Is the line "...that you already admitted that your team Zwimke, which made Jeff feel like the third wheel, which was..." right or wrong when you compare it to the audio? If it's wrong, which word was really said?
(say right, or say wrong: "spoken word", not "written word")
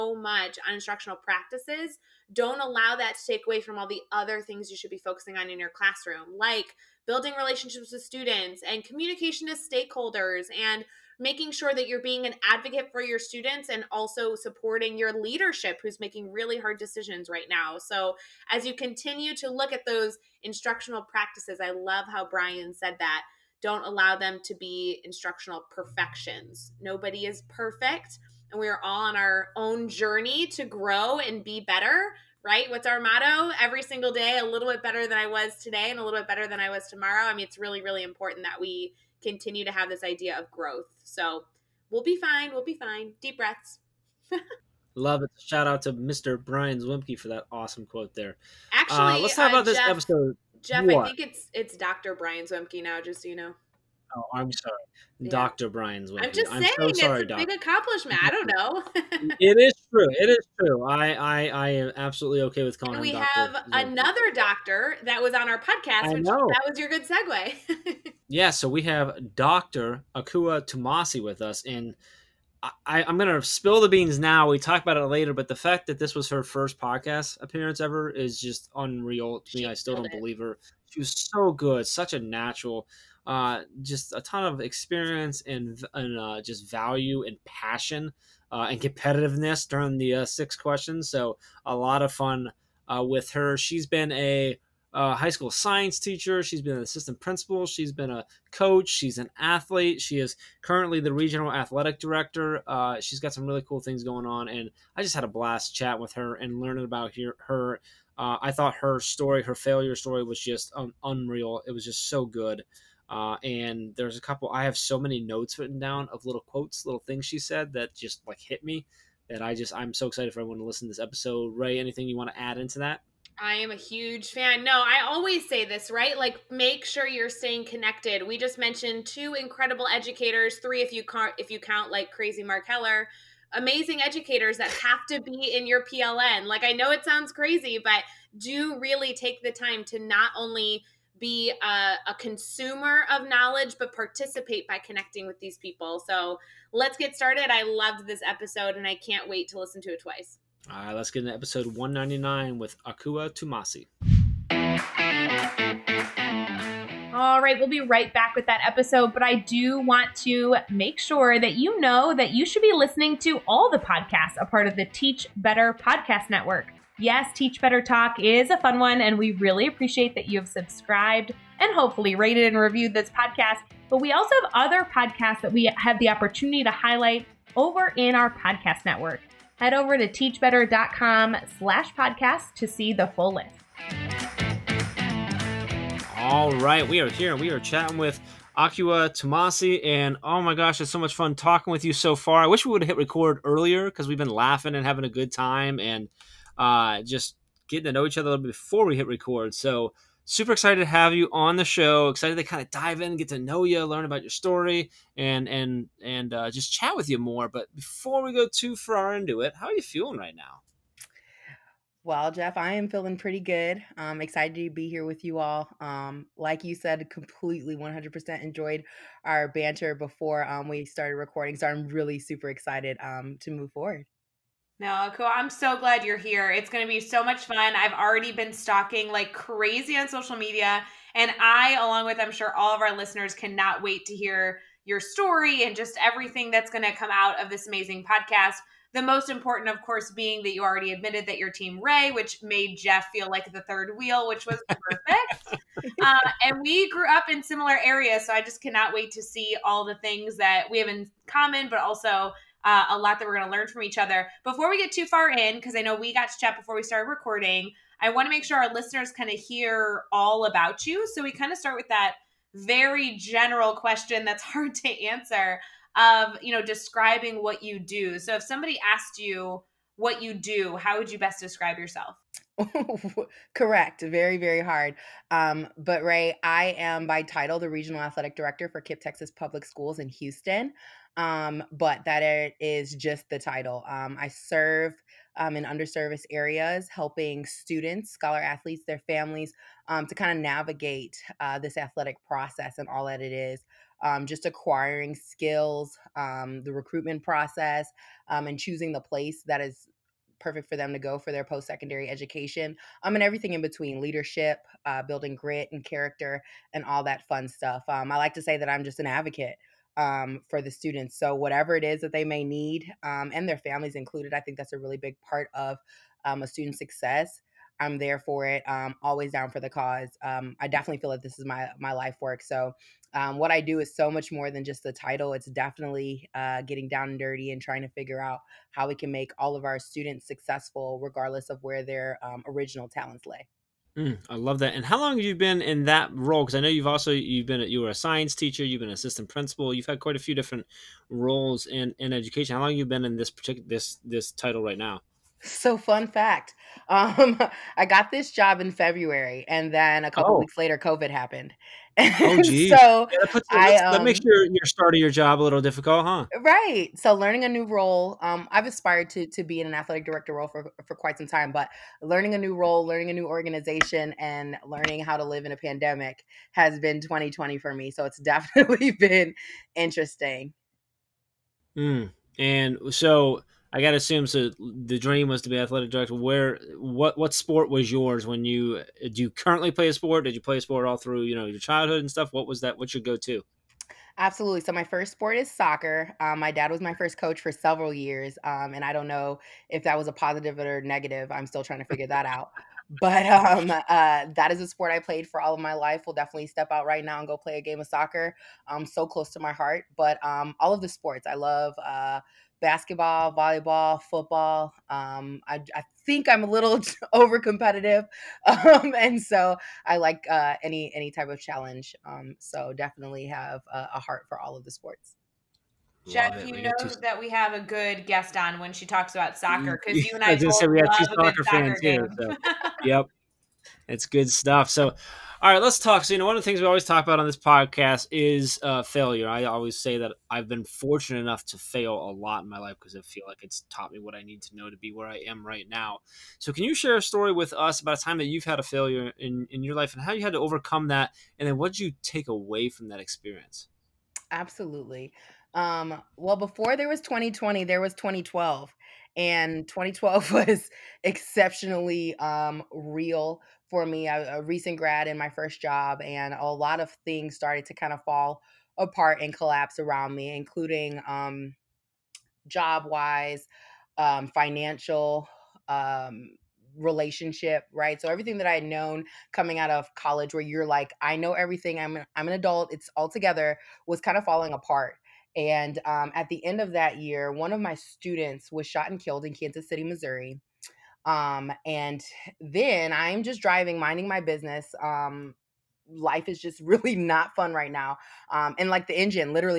wrong: "Ray", not "Zwimke".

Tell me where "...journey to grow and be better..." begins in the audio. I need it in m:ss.
0:29.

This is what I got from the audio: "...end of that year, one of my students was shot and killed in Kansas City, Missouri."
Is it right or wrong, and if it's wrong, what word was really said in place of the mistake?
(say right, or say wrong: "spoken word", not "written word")
right.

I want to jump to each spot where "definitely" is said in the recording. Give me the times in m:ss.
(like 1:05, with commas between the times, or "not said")
5:20, 5:25, 6:08, 6:36, 6:52.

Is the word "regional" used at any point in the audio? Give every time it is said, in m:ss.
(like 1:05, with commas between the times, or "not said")
1:41, 4:37.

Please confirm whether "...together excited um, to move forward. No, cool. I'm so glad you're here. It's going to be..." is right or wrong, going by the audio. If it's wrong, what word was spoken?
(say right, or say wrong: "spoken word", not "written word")
wrong: "super", not "together".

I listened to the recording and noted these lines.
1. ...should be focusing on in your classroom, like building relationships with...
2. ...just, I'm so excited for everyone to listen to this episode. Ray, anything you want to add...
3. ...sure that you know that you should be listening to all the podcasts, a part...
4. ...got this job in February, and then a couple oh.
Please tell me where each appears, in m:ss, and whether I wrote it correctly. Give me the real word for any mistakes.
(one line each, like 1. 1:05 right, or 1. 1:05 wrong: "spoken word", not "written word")
1. 0:04 right
2. 1:59 right
3. 2:40 right
4. 5:47 right.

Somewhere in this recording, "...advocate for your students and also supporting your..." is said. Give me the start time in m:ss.
0:12.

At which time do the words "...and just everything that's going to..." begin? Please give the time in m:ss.
3:55.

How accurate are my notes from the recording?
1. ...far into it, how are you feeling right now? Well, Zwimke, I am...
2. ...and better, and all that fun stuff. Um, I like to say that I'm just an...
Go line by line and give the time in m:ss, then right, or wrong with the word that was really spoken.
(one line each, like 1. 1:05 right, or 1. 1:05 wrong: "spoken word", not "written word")
1. 3:28 wrong: "Jeff", not "Zwimke"
2. 5:05 wrong: "character", not "better".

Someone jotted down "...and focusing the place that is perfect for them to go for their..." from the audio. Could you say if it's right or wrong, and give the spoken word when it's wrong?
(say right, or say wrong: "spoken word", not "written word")
wrong: "choosing", not "focusing".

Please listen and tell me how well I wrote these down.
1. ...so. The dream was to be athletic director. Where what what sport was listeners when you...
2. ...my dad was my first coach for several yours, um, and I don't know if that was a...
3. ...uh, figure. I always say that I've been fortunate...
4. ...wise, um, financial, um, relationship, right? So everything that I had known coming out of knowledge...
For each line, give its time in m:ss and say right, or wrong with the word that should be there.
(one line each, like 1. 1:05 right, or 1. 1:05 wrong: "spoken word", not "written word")
1. 6:14 wrong: "yours", not "listeners"
2. 6:26 wrong: "years", not "yours"
3. 7:08 wrong: "failure", not "figure"
4. 7:42 wrong: "college", not "knowledge".